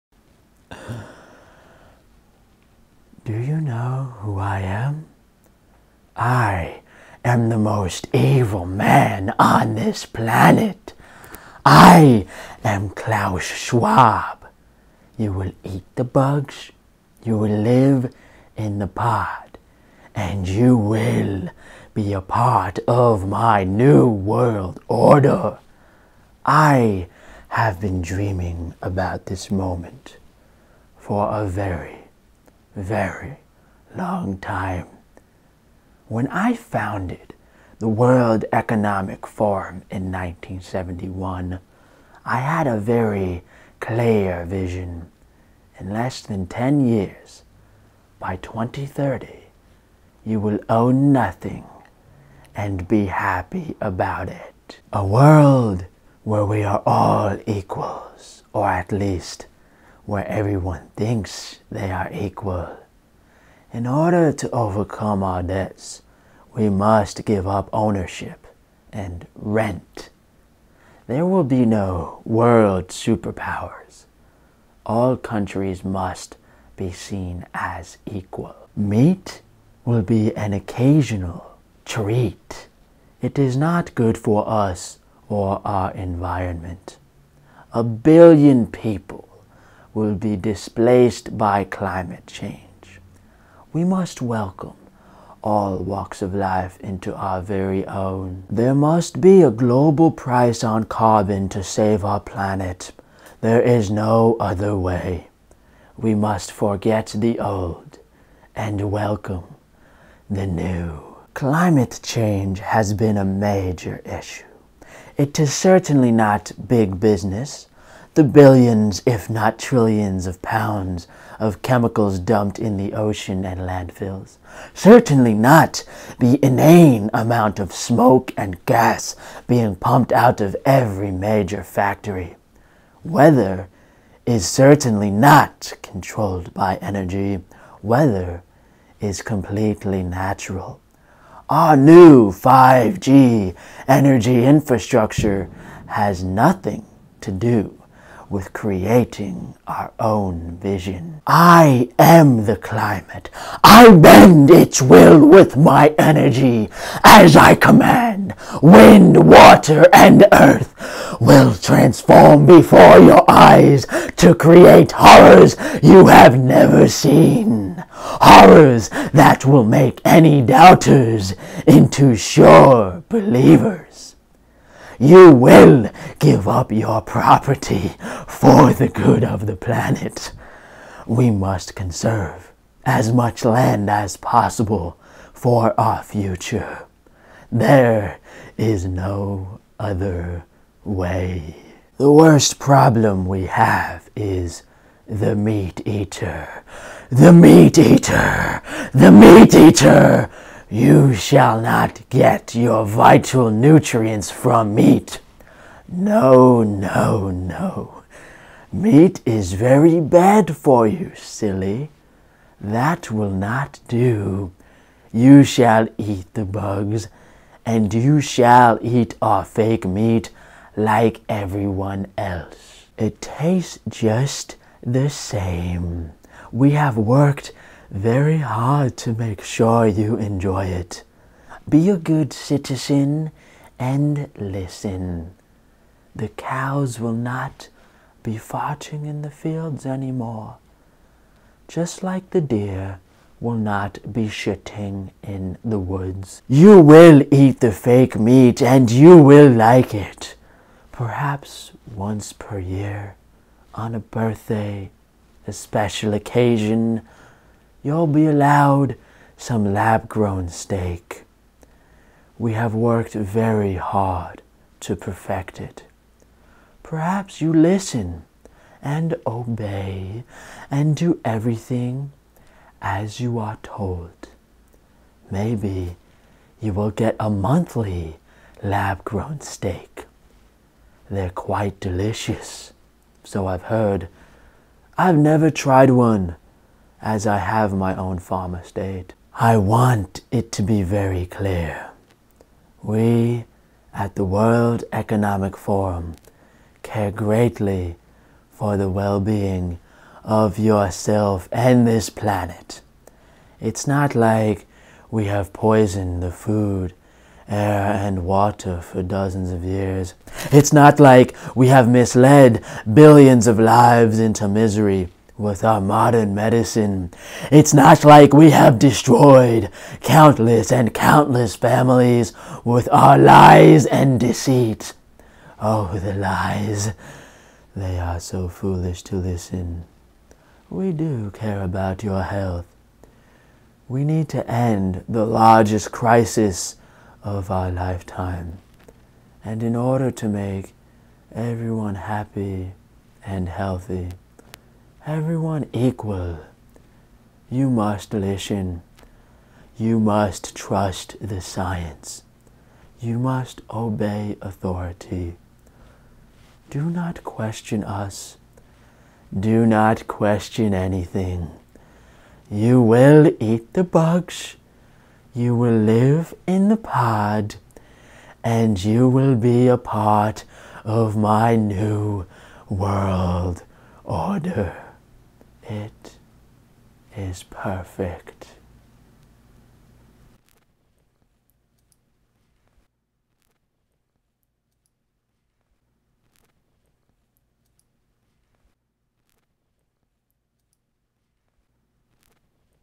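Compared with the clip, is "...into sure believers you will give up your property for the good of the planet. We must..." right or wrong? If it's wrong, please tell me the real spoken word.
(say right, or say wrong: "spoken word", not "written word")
right.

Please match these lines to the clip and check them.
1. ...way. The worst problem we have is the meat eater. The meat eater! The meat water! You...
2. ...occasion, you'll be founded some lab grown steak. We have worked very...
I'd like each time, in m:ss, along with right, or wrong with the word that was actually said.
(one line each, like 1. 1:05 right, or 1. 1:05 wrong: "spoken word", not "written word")
1. 3:10 wrong: "eater", not "water"
2. 4:16 wrong: "allowed", not "founded".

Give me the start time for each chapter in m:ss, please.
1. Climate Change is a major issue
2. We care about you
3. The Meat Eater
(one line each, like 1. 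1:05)
1. 1:51
2. 4:49
3. 3:11.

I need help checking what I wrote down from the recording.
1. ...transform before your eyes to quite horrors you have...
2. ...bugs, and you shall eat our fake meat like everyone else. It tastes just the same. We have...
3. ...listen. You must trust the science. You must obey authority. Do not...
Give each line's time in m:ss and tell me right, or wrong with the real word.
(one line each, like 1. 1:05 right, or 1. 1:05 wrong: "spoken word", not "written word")
1. 2:41 wrong: "create", not "quite"
2. 3:36 right
3. 5:48 right.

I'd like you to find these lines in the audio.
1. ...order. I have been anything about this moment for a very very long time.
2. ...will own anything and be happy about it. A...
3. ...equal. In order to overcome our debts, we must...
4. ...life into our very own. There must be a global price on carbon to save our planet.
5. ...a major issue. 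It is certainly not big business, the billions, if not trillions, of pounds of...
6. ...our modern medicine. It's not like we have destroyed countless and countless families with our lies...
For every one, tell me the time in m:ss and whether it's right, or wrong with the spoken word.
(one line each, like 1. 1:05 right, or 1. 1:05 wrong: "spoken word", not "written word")
1. 0:24 wrong: "dreaming", not "anything"
2. 0:50 wrong: "nothing", not "anything"
3. 1:02 right
4. 1:36 right
5. 1:53 right
6. 5:15 right.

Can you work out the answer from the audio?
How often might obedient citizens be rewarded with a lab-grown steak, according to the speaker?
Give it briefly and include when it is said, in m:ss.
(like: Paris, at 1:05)
Monthly, at 4:37.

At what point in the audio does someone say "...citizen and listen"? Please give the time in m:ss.
3:52.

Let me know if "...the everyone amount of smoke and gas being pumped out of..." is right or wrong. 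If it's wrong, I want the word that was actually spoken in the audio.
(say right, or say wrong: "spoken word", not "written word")
wrong: "inane", not "everyone".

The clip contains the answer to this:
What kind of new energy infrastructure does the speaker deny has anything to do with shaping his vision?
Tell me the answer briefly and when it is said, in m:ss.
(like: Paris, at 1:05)
5G, at 2:22.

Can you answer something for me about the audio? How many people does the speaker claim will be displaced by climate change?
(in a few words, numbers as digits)
A billion.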